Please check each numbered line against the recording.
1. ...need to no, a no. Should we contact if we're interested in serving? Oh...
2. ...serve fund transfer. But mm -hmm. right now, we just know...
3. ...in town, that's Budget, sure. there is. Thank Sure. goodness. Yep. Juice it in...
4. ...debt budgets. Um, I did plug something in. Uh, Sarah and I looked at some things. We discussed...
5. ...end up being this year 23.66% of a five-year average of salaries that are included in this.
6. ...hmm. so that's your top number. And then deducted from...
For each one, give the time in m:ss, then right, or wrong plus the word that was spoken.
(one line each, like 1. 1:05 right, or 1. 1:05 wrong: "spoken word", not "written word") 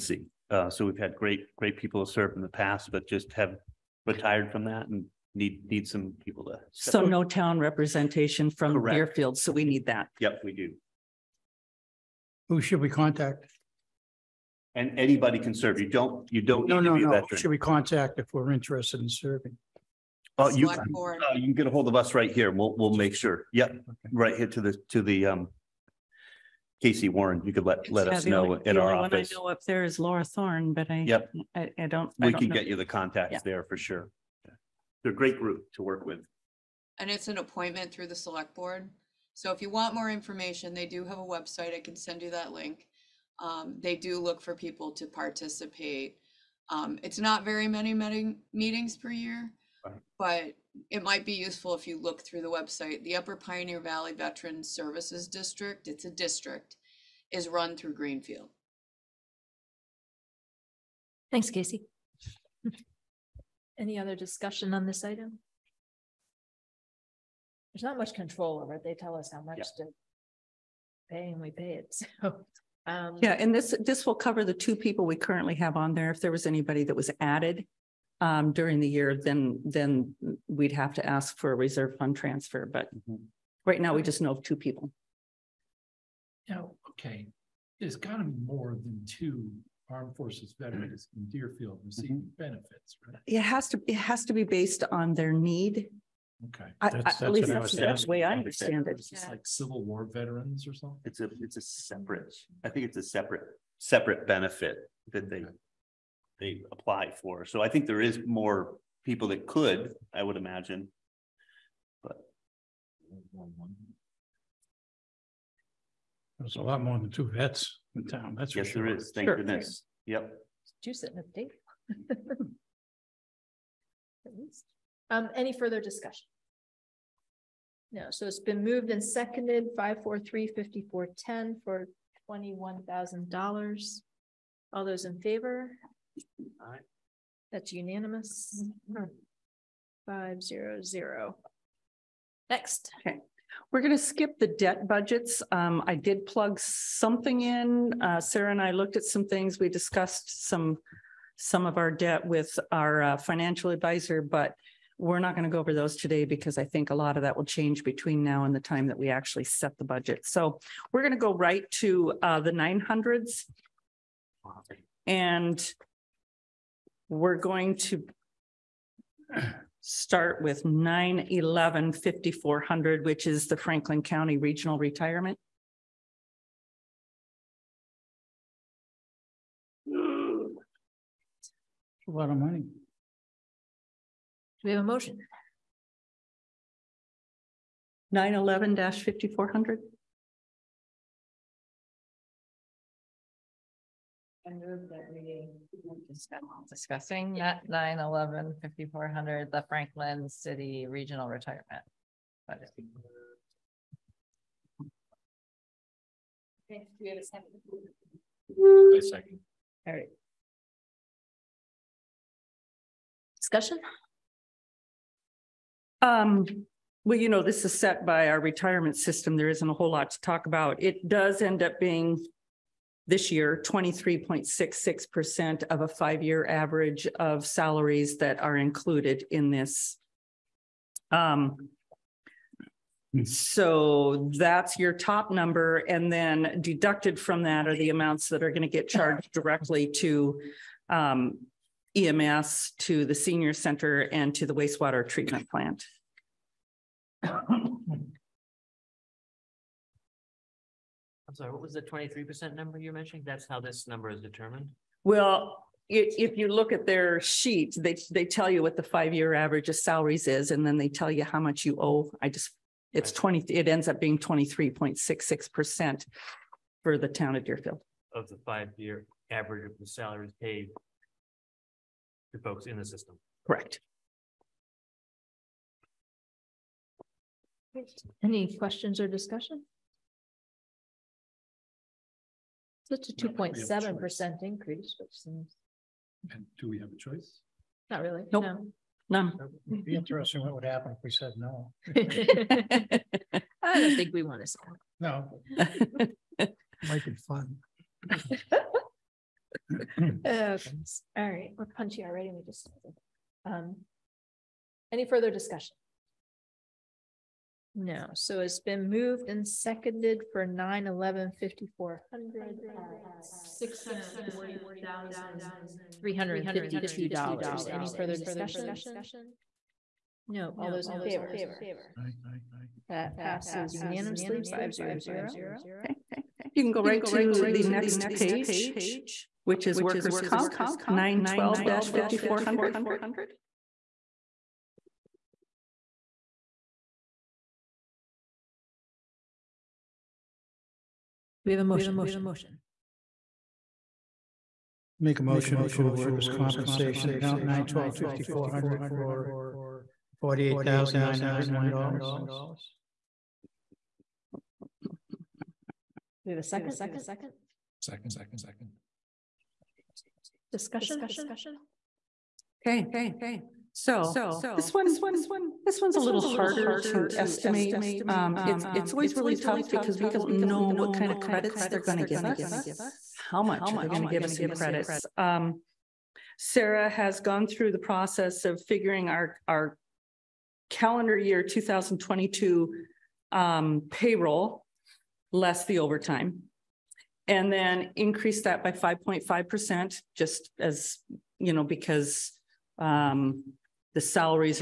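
1. 0:16 right
2. 1:21 wrong: "reserve", not "serve"
3. 1:57 wrong: "Yes", not "Budget"
4. 2:24 right
5. 3:41 right
6. 3:53 right.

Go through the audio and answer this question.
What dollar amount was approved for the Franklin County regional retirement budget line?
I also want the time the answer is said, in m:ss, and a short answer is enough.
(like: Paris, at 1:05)
$640,352, at 5:13.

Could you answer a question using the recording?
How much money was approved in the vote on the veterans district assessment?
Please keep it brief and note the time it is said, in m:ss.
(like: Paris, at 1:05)
$21,000, at 2:12.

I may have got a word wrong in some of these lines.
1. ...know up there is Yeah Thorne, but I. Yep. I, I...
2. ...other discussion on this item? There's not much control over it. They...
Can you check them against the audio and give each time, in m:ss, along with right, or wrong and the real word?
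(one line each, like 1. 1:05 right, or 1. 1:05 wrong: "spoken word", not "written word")
1. 0:29 wrong: "Laura", not "Yeah"
2. 1:03 right.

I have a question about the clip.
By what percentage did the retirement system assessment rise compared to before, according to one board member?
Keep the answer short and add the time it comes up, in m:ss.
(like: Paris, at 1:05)
2.7%, at 4:43.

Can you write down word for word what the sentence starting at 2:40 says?
So we're going to go right to uh, the 900s.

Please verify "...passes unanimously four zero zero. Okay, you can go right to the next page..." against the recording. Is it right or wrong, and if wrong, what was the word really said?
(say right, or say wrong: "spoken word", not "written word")
wrong: "five", not "four".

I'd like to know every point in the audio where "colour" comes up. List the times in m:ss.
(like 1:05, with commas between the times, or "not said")
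not said.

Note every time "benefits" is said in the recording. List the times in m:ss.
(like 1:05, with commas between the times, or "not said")
1:32, 1:44.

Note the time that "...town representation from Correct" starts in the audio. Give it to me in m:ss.
0:07.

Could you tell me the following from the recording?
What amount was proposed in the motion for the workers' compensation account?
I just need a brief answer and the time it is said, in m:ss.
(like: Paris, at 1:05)
$48,901, at 5:50.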